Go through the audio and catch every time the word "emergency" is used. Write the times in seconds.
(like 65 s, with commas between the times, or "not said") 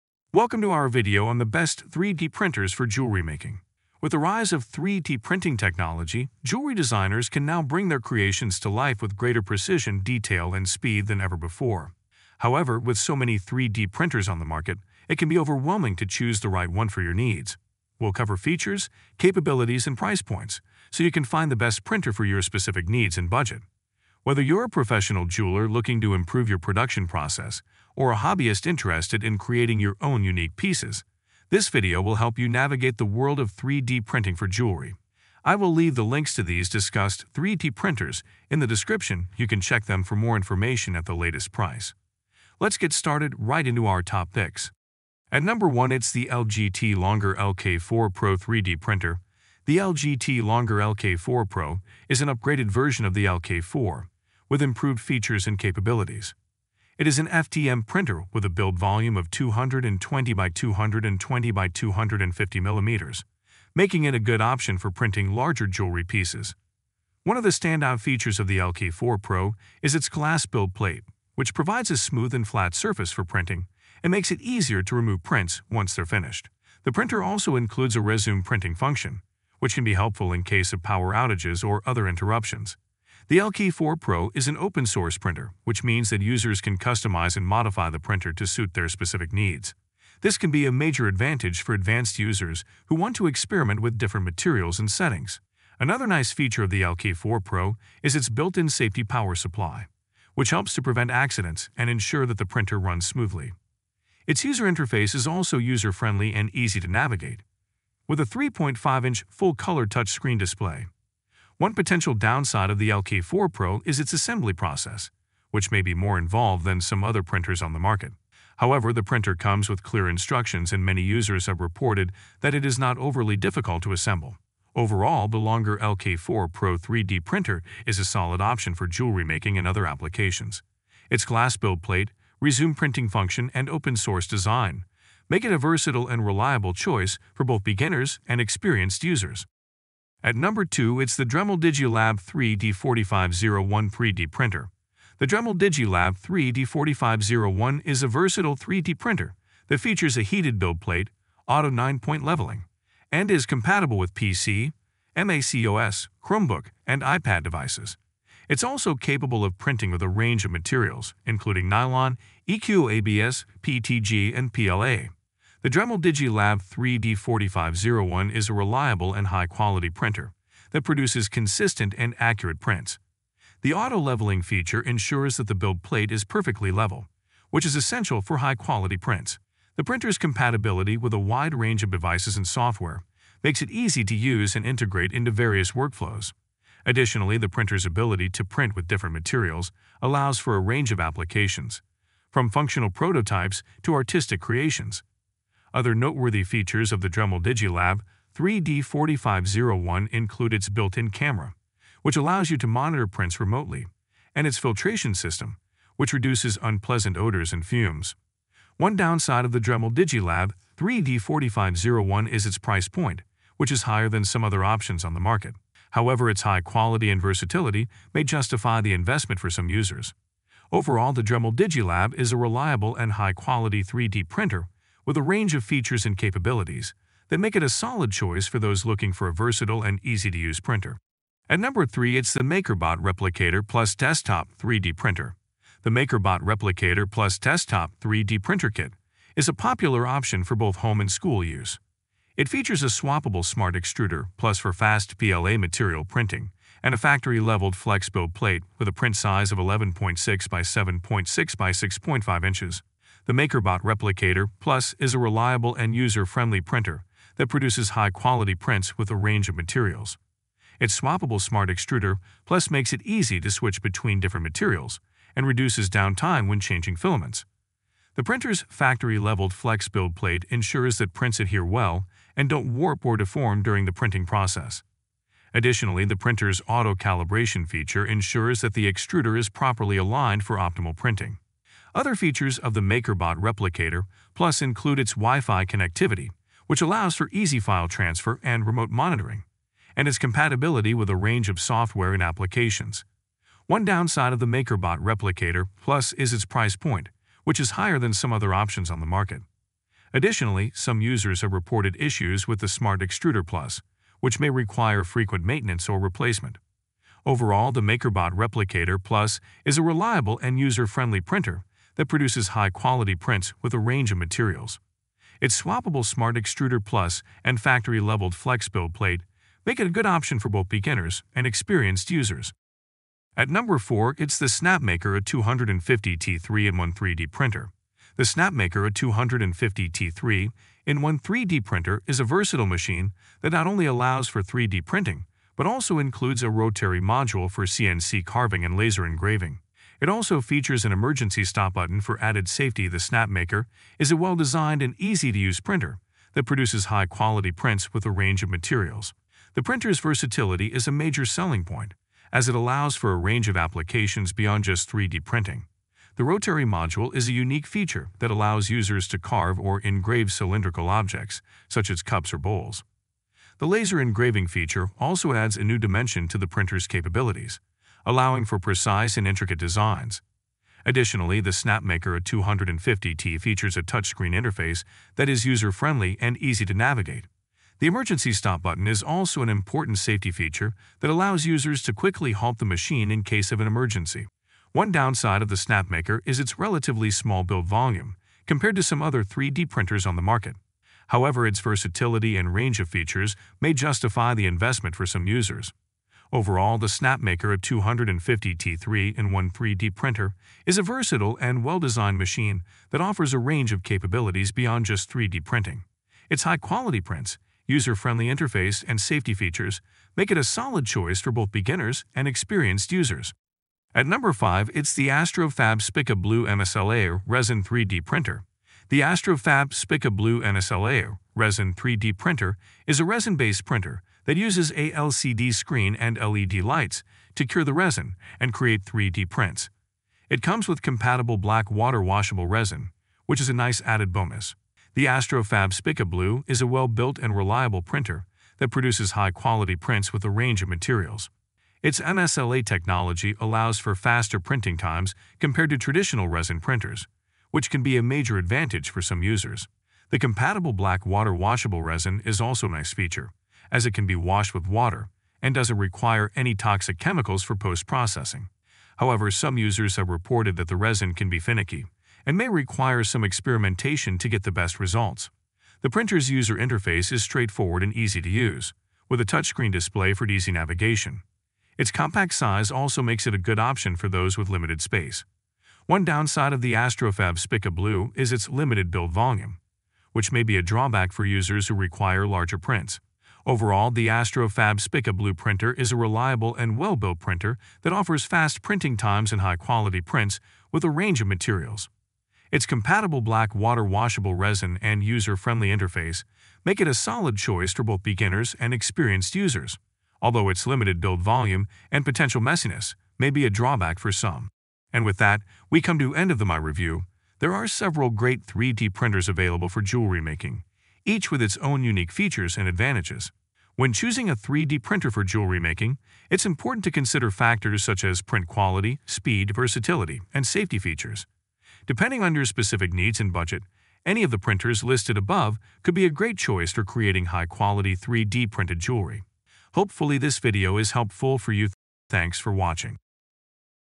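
340 s, 377 s, 383 s.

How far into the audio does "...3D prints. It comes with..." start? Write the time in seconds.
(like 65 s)
428 s.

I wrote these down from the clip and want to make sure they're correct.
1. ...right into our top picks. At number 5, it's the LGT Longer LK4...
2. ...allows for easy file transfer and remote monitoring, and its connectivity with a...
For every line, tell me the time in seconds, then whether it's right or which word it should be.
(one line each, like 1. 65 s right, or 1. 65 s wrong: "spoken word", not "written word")
1. 43 s wrong: "1", not "5"
2. 286 s wrong: "compatibility", not "connectivity".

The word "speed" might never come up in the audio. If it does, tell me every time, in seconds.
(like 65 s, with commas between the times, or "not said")
10 s, 519 s.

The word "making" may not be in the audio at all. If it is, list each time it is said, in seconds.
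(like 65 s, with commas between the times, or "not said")
3 s, 63 s, 129 s, 510 s, 515 s.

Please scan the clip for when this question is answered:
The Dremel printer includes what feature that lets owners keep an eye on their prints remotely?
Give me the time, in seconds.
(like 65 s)
200 s.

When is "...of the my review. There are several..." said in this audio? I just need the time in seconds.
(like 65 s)
506 s.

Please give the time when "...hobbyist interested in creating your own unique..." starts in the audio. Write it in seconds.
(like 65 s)
28 s.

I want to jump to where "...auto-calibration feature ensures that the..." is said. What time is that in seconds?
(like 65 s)
276 s.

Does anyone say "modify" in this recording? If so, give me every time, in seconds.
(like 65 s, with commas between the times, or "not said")
87 s.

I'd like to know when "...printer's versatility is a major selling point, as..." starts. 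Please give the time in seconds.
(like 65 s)
349 s.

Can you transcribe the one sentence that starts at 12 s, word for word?
However, with so many 3D printers on the market, it can be overwhelming to choose the right one for your needs.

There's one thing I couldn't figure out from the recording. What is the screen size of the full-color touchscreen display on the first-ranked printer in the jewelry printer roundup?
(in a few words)
3.5-inch.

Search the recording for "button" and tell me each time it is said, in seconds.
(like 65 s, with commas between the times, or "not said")
341 s, 378 s.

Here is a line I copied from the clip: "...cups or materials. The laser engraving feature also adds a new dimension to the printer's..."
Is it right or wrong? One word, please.
wrong.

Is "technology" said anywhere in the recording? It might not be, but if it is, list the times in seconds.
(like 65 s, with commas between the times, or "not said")
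5 s, 442 s.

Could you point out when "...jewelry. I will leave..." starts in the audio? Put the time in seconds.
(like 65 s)
34 s.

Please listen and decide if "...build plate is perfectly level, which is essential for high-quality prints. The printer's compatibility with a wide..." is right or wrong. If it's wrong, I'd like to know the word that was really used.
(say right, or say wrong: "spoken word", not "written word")
right.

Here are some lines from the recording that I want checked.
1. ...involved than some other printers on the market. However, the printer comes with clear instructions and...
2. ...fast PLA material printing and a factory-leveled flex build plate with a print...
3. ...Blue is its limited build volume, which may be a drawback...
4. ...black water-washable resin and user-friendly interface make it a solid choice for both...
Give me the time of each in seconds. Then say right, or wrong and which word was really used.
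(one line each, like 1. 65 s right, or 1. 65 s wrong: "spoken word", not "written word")
1. 116 s right
2. 244 s right
3. 477 s right
4. 493 s right.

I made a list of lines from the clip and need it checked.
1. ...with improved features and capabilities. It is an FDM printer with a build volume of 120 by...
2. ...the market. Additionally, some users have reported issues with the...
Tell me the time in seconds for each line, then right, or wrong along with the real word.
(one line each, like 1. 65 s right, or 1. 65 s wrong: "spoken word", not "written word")
1. 54 s wrong: "220", not "120"
2. 299 s right.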